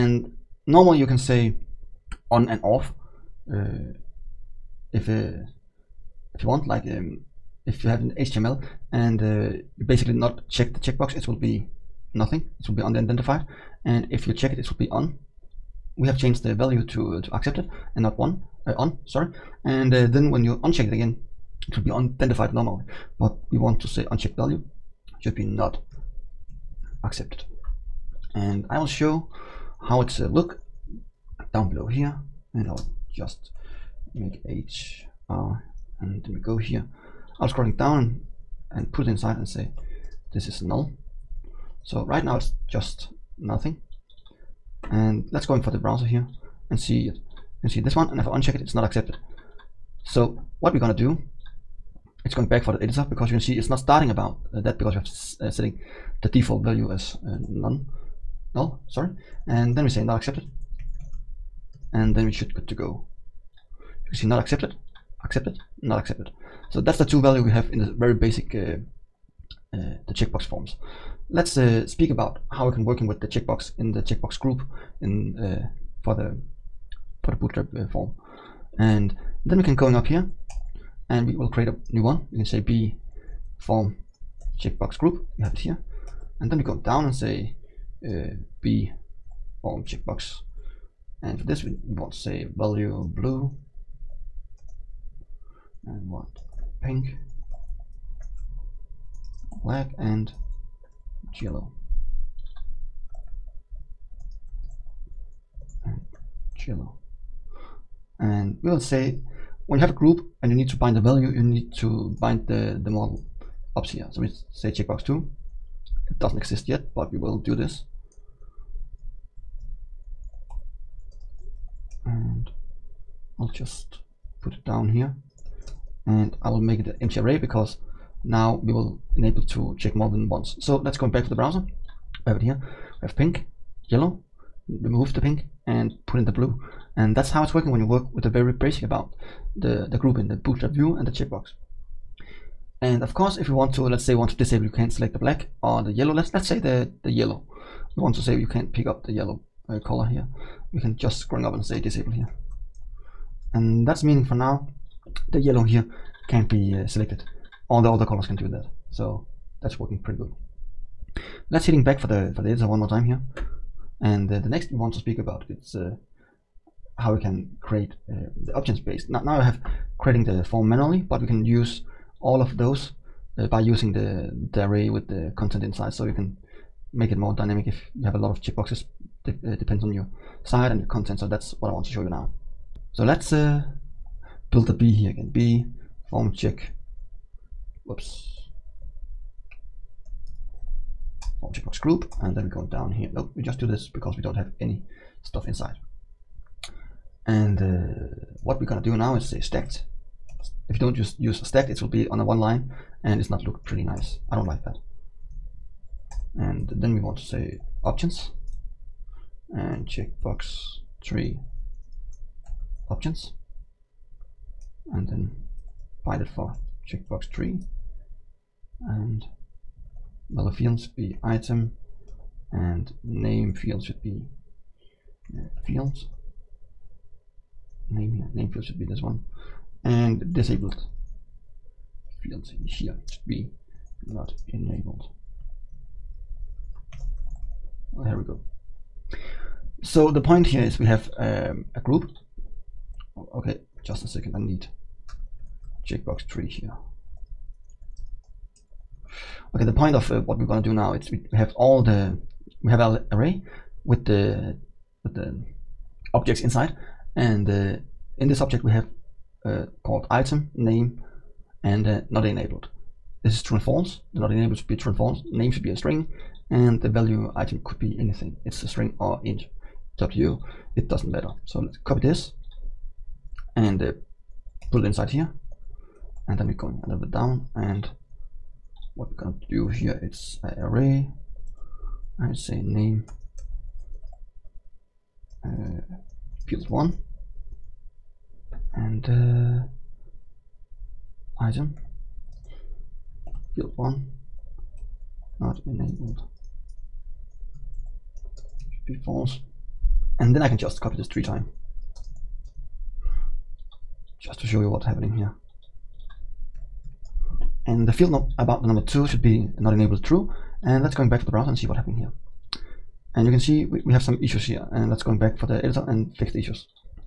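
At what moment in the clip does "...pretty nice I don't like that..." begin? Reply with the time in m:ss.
3:23.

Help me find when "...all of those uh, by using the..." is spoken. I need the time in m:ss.
2:52.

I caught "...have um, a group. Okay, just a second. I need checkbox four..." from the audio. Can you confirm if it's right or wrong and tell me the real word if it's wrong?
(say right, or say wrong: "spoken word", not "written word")
wrong: "three", not "four".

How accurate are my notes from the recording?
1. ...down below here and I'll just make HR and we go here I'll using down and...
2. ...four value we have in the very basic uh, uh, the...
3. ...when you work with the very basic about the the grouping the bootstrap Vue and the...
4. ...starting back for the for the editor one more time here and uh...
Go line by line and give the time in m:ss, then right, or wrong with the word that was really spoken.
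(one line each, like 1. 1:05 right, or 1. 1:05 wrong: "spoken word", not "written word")
1. 0:31 wrong: "scrolling", not "using"
2. 1:07 wrong: "two", not "four"
3. 2:17 right
4. 2:41 wrong: "heading", not "starting".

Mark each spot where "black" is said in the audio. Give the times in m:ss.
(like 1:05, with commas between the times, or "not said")
1:39, 2:25.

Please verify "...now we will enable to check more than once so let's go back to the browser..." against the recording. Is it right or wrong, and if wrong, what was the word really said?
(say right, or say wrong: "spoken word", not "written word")
right.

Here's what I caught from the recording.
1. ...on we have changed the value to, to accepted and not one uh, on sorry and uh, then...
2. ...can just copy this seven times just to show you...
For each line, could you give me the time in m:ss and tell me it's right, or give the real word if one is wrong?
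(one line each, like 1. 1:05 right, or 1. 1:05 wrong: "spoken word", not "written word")
1. 0:14 right
2. 5:00 wrong: "three", not "seven".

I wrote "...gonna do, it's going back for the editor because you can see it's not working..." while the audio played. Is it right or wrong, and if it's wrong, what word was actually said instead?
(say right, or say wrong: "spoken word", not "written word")
wrong: "starting", not "working".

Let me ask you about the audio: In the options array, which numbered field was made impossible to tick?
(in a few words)
2.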